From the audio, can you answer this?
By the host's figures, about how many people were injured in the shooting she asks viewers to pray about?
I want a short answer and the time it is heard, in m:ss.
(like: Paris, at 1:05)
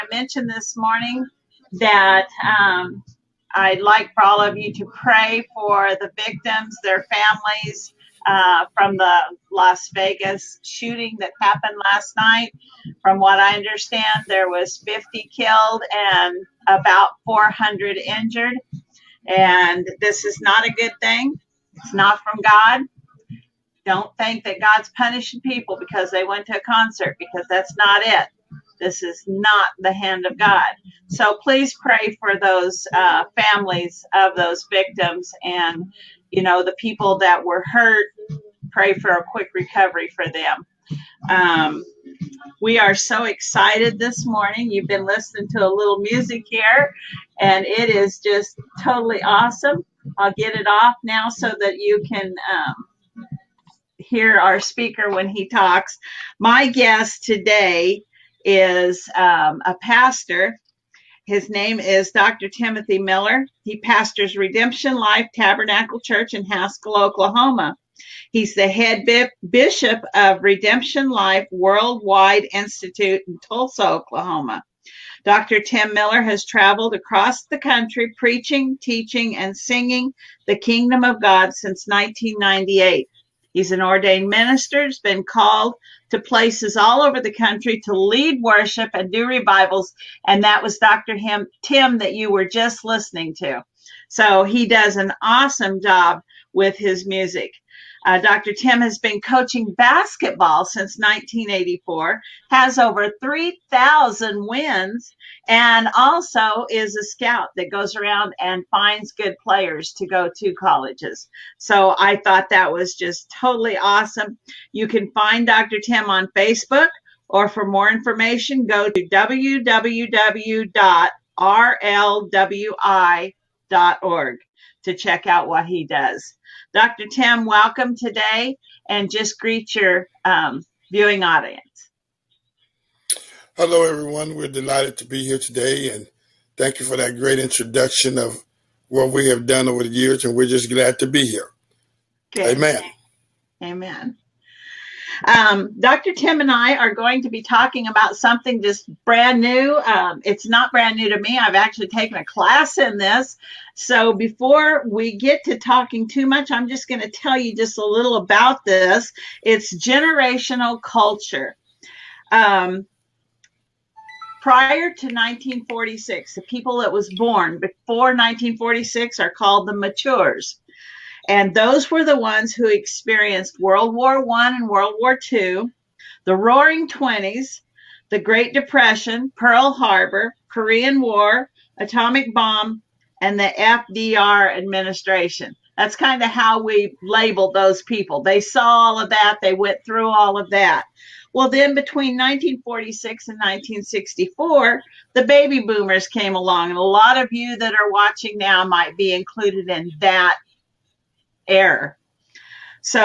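400, at 0:16.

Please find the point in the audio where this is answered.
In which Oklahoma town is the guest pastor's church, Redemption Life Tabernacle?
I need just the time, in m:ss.
1:06.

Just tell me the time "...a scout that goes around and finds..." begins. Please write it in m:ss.
1:46.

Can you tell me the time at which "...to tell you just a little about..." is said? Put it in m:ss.
2:37.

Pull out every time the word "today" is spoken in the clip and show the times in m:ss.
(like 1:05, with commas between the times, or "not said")
0:57, 2:07, 2:15.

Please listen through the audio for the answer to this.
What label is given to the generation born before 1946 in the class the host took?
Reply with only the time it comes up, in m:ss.
2:49.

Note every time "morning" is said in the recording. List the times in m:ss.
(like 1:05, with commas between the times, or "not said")
0:00, 0:44.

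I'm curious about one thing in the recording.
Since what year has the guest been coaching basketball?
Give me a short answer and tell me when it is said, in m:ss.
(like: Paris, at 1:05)
1984, at 1:40.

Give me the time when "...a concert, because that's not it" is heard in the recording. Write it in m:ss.
0:26.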